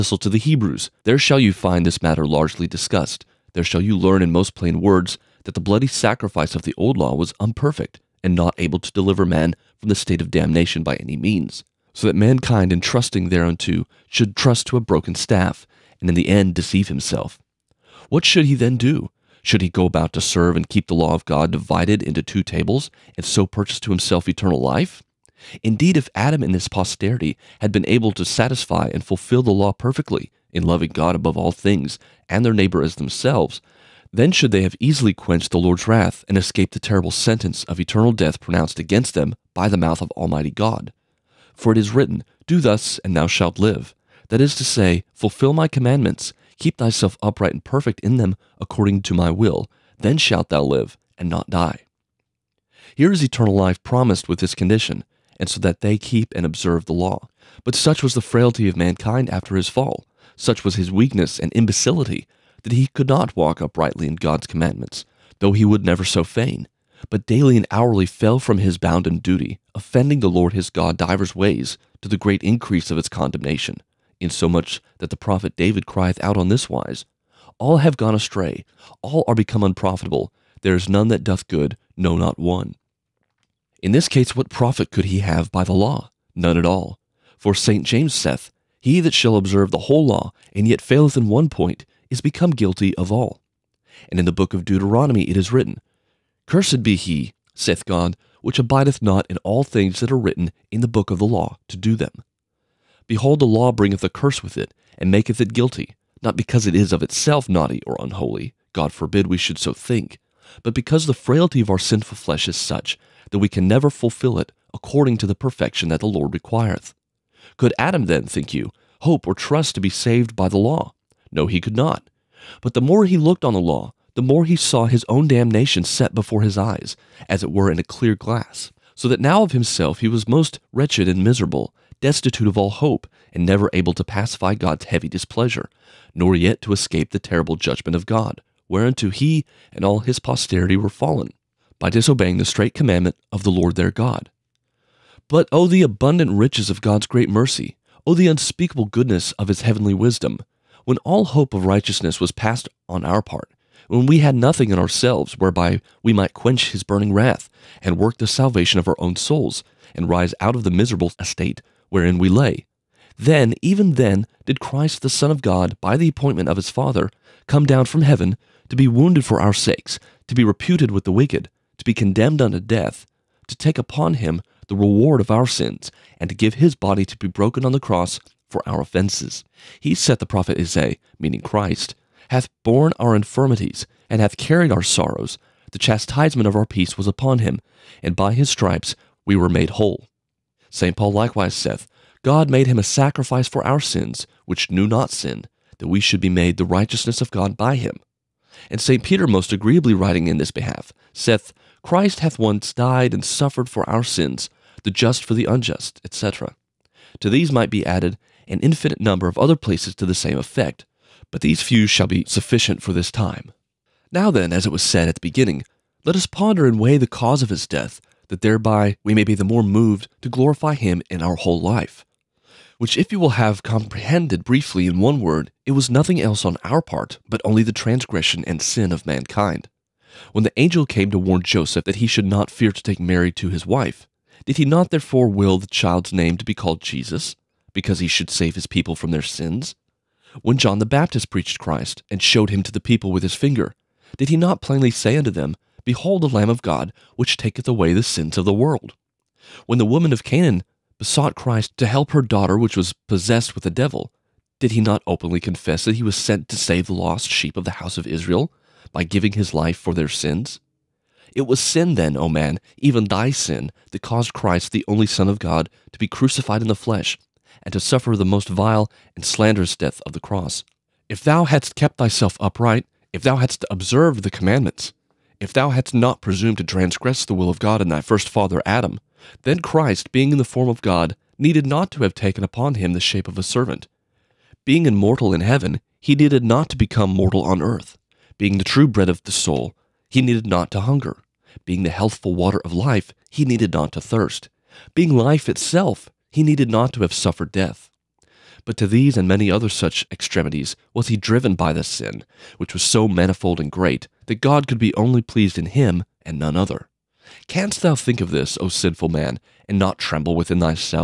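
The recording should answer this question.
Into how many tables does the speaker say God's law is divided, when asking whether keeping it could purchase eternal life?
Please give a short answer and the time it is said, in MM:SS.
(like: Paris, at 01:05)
2, at 00:22.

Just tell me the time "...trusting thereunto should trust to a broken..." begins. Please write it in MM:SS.
00:12.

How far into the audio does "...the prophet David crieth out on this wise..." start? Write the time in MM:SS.
01:15.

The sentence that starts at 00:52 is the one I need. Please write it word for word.
Here is eternal life promised with this condition and so that they keep and observe the law.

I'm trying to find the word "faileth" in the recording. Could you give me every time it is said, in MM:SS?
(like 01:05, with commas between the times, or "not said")
01:30.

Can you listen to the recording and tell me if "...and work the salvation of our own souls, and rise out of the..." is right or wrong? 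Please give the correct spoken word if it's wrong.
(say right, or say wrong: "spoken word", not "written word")
right.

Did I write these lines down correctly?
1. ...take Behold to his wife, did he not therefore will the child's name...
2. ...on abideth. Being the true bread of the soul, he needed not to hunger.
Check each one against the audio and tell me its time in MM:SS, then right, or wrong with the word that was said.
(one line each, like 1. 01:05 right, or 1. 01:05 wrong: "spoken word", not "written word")
1. 03:52 wrong: "Mary", not "Behold"
2. 04:47 wrong: "earth", not "abideth".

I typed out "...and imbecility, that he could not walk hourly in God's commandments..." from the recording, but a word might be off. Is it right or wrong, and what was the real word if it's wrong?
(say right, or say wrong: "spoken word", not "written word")
wrong: "uprightly", not "hourly".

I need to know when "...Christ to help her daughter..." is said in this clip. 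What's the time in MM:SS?
04:11.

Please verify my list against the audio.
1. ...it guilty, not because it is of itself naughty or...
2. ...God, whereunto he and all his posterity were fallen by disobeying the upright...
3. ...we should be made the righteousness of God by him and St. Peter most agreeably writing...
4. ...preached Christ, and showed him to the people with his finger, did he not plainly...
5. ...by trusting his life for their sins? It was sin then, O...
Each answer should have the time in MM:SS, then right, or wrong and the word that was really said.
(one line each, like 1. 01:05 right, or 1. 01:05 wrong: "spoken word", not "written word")
1. 01:45 right
2. 02:18 wrong: "straight", not "upright"
3. 03:15 right
4. 04:01 right
5. 04:18 wrong: "giving", not "trusting".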